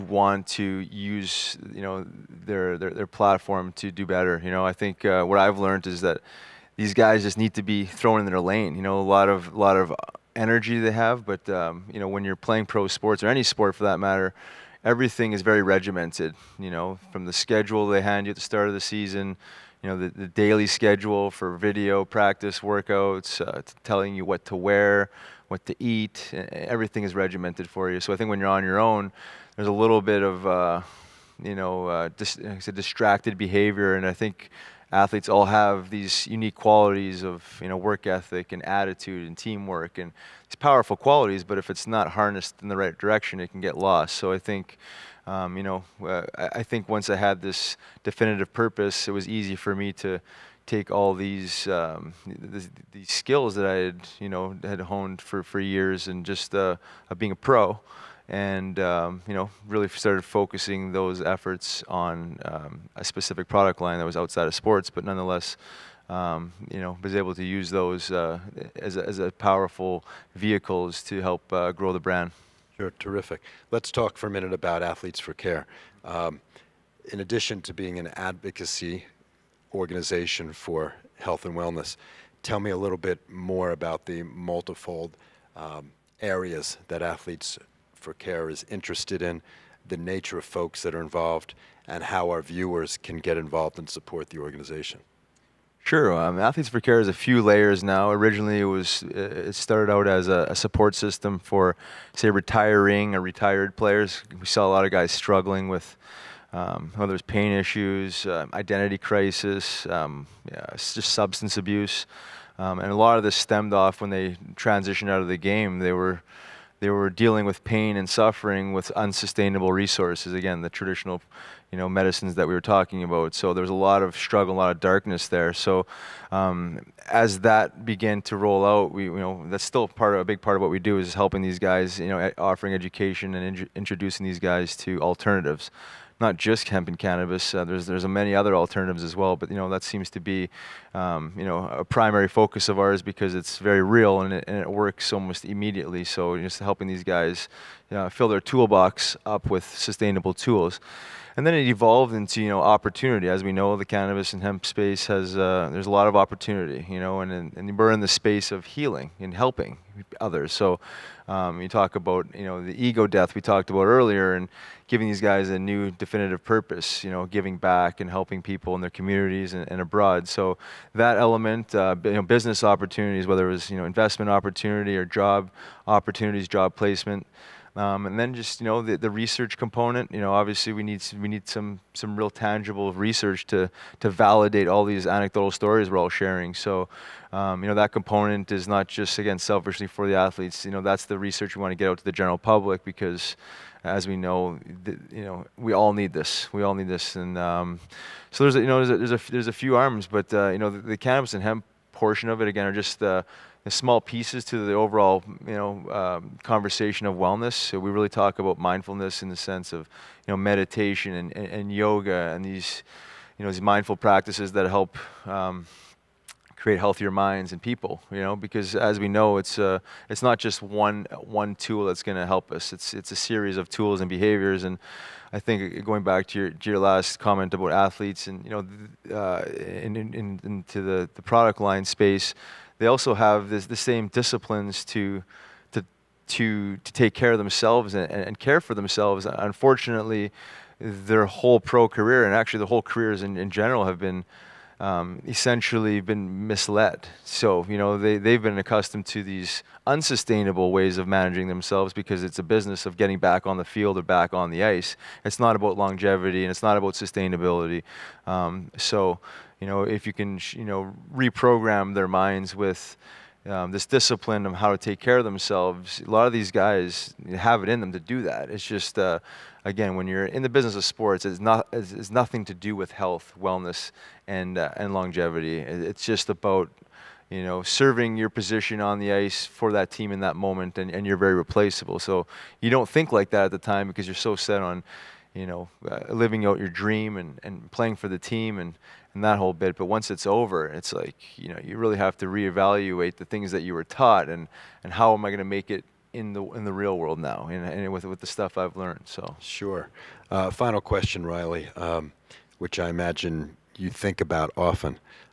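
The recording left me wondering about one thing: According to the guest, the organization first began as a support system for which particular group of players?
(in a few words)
retiring or retired players.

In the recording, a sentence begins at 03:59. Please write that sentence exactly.
Unfortunately, their whole pro career and actually the whole careers in, in general have been um, essentially been misled.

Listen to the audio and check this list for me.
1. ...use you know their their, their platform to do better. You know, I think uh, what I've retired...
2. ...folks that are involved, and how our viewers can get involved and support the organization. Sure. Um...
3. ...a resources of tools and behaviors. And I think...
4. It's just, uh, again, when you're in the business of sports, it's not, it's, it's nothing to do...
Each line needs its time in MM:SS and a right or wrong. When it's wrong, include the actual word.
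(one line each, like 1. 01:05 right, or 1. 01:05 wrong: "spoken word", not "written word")
1. 00:00 wrong: "learned", not "retired"
2. 01:30 right
3. 03:43 wrong: "series", not "resources"
4. 04:28 right.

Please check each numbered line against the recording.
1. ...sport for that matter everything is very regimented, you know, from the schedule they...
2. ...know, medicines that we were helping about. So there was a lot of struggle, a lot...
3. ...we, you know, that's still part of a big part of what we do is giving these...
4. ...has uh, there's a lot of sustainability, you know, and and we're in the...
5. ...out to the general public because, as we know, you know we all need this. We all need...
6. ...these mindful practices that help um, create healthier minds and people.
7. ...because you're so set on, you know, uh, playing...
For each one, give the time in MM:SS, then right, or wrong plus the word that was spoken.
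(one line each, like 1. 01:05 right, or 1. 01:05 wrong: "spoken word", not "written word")
1. 00:13 right
2. 02:01 wrong: "talking", not "helping"
3. 02:08 wrong: "helping", not "giving"
4. 02:35 wrong: "opportunity", not "sustainability"
5. 03:11 right
6. 03:33 right
7. 04:43 wrong: "living", not "playing".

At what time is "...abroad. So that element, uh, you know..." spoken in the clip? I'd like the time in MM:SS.
02:49.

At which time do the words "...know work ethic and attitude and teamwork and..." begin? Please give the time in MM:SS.
00:37.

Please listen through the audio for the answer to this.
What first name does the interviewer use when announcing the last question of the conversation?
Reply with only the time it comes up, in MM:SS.
05:01.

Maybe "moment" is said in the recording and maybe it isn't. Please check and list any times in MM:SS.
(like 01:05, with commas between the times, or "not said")
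04:40.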